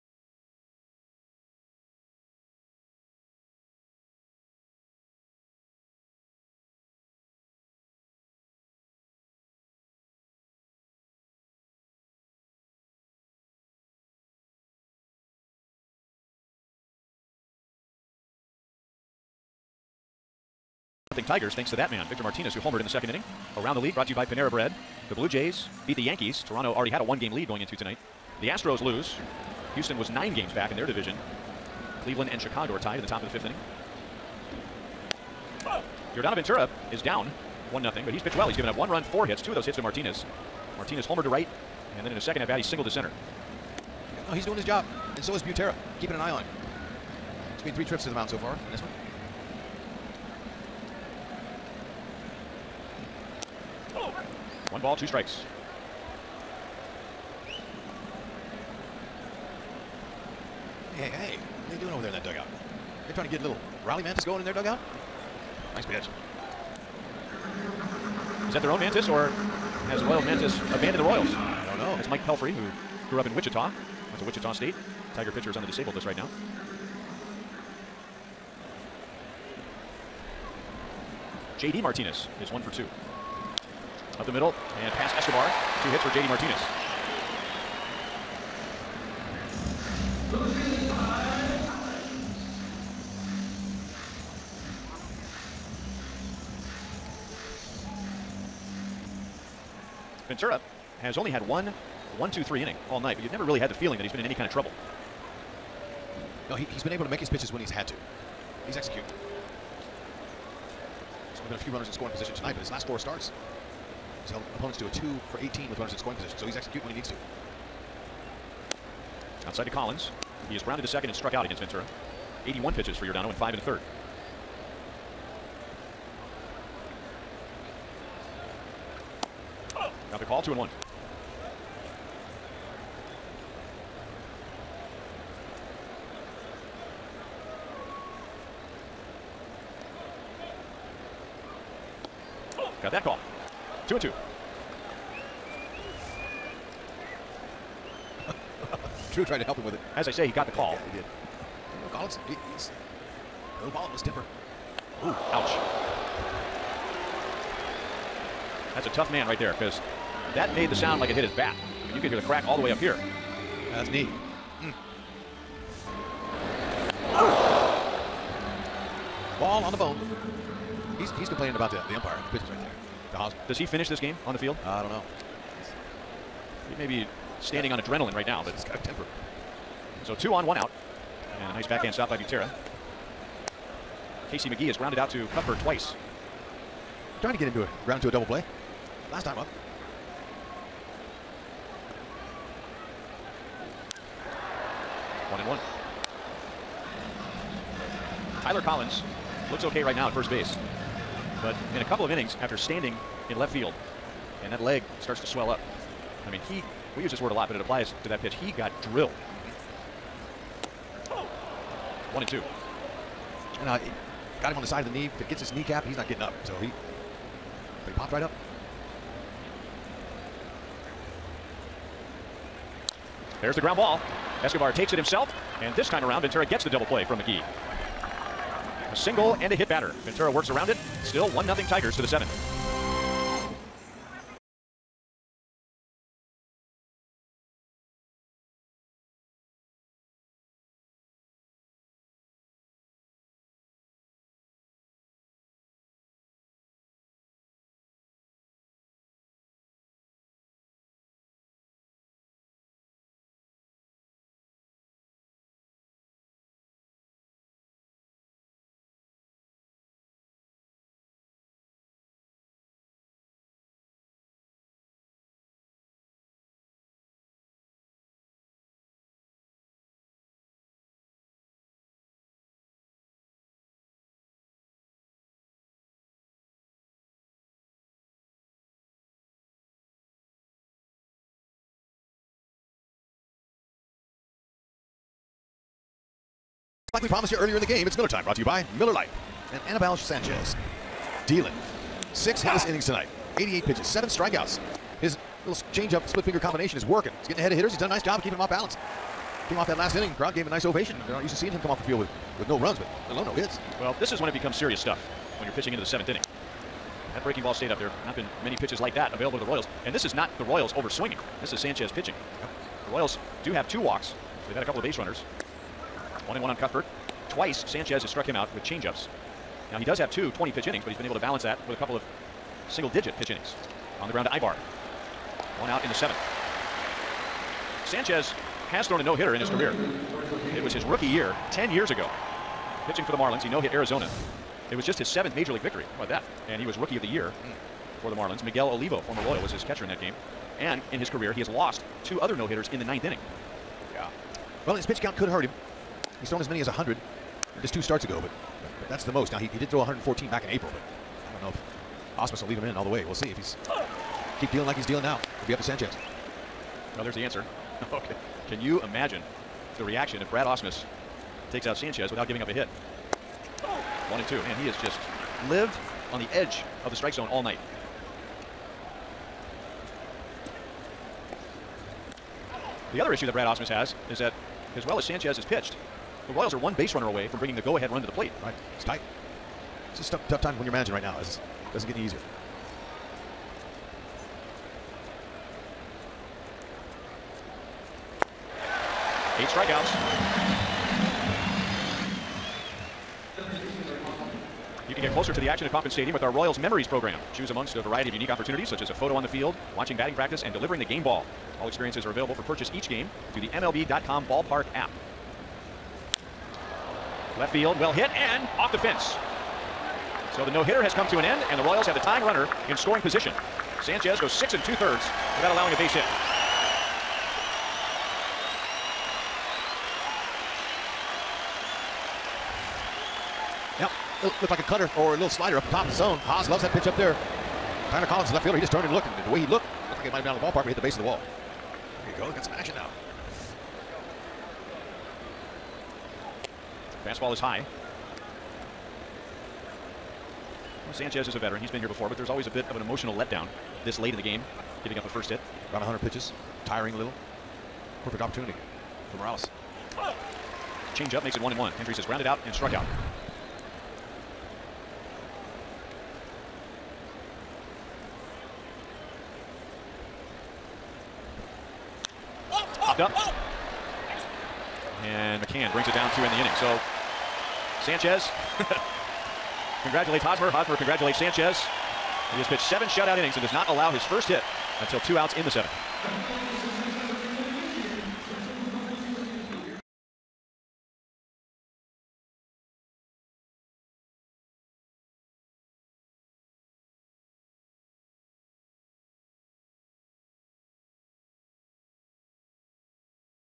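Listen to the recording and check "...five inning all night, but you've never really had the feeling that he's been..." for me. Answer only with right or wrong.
wrong.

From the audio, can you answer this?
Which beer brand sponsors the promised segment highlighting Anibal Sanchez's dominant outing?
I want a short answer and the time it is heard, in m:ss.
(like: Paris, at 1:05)
Miller Lite, at 4:48.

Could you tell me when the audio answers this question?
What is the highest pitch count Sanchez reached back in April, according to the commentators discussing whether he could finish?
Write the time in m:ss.
5:49.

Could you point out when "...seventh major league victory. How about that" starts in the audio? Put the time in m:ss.
5:35.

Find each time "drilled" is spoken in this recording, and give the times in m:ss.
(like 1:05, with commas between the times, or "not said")
3:28.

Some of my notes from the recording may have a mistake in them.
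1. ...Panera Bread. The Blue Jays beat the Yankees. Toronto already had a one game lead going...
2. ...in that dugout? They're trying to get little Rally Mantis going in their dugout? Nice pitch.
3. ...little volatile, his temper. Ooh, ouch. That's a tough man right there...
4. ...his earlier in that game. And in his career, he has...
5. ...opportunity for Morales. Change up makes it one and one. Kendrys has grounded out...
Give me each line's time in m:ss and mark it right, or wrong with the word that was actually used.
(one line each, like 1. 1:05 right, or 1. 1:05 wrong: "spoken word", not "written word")
1. 0:24 right
2. 1:02 right
3. 2:33 right
4. 5:39 wrong: "catcher", not "earlier"
5. 7:28 right.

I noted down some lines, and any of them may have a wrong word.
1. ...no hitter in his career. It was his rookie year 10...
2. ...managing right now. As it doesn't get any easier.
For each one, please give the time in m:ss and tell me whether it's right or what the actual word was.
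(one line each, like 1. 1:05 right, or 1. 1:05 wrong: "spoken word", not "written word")
1. 5:29 right
2. 6:20 right.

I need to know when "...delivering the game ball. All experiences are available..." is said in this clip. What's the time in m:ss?
6:40.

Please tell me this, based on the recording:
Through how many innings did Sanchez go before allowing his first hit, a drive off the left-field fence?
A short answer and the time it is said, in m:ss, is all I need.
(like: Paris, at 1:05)
6 2/3, at 6:54.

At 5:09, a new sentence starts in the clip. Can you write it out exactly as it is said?
And this is not the Royals over swinging.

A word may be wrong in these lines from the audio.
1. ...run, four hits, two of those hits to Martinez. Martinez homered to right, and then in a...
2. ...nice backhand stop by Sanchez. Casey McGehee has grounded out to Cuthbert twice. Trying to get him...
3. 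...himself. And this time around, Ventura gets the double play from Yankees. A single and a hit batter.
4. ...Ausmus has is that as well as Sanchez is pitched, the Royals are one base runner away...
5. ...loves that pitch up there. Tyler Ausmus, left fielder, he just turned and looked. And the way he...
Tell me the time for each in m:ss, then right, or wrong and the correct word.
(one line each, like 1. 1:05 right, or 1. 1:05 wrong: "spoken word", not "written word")
1. 0:38 right
2. 3:01 wrong: "Butera", not "Sanchez"
3. 3:44 wrong: "McGehee", not "Yankees"
4. 6:13 right
5. 7:06 wrong: "Collins", not "Ausmus".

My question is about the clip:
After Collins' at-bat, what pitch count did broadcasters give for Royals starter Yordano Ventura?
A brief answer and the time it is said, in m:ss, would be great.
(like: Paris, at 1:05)
81, at 2:02.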